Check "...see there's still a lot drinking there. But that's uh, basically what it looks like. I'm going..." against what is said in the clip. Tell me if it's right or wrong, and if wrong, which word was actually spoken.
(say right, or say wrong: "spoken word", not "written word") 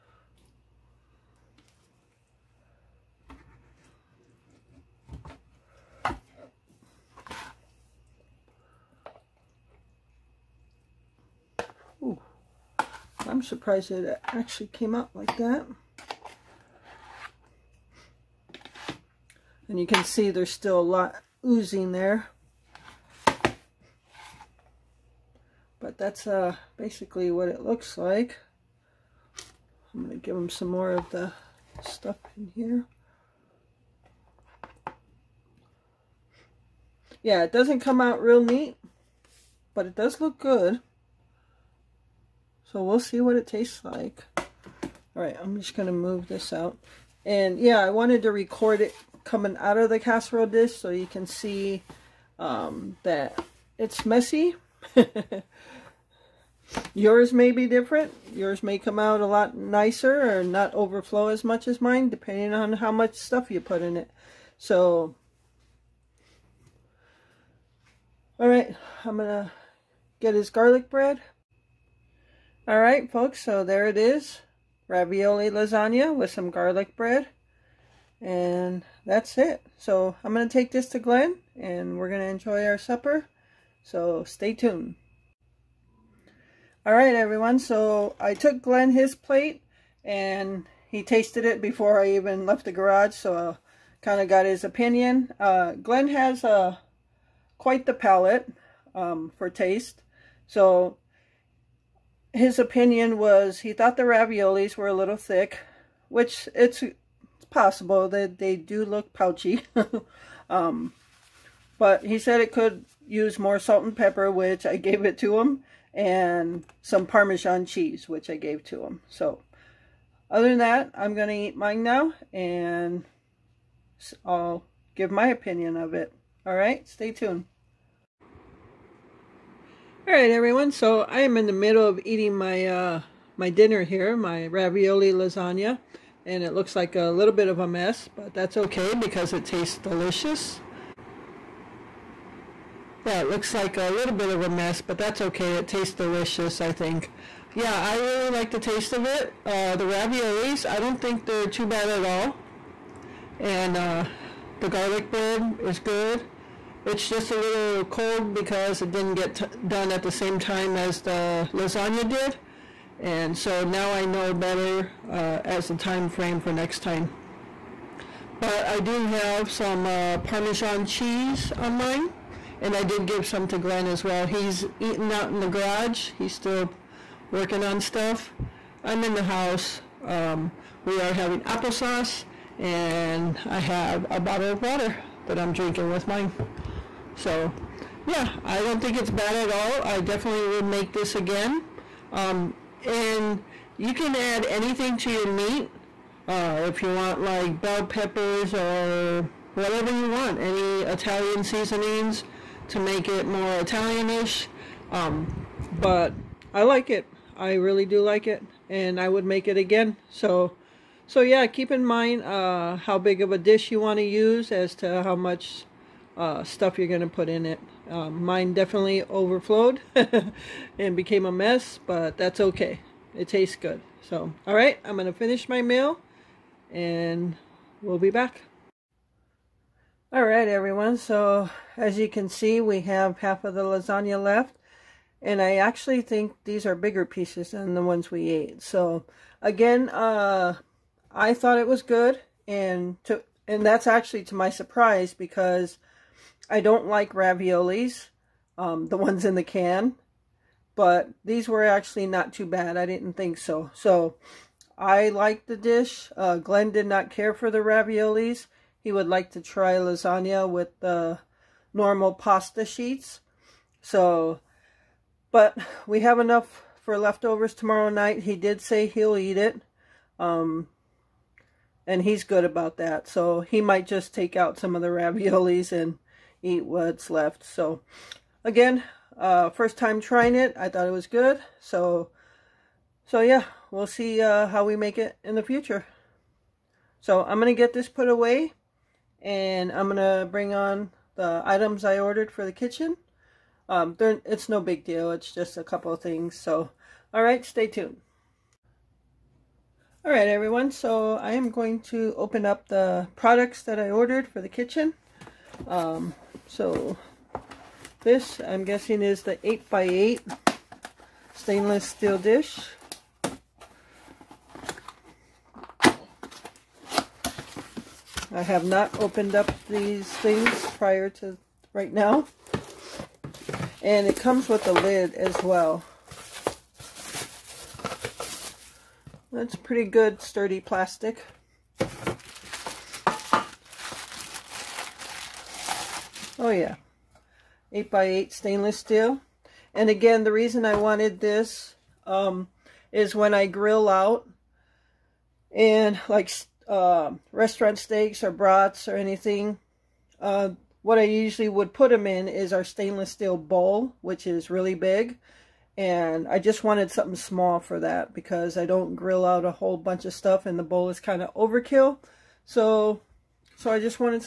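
wrong: "oozing", not "drinking".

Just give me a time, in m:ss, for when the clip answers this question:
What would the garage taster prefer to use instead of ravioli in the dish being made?
4:21.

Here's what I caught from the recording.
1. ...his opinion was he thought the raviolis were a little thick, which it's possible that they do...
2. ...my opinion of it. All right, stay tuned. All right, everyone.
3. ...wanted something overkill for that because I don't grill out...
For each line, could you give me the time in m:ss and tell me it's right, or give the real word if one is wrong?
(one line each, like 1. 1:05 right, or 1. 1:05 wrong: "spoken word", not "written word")
1. 1:42 right
2. 2:05 right
3. 5:56 wrong: "small", not "overkill".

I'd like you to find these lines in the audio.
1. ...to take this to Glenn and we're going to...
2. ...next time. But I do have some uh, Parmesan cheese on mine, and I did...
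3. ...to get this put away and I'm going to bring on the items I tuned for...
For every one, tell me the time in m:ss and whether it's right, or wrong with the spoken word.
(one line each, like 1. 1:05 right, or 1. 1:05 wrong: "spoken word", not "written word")
1. 1:20 right
2. 2:46 right
3. 4:47 wrong: "ordered", not "tuned".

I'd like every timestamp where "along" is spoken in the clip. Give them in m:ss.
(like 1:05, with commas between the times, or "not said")
not said.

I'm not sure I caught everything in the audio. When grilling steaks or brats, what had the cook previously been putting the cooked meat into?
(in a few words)
stainless steel bowl.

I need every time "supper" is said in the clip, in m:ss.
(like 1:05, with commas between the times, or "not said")
1:22.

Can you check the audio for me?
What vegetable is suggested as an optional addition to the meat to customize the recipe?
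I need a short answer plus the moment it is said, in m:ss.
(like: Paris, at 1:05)
bell peppers, at 3:17.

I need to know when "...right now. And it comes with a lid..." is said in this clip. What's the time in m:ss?
5:21.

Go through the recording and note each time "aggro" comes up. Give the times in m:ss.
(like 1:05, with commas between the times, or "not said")
not said.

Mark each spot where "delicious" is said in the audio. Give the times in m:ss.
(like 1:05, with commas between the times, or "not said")
2:19, 2:25.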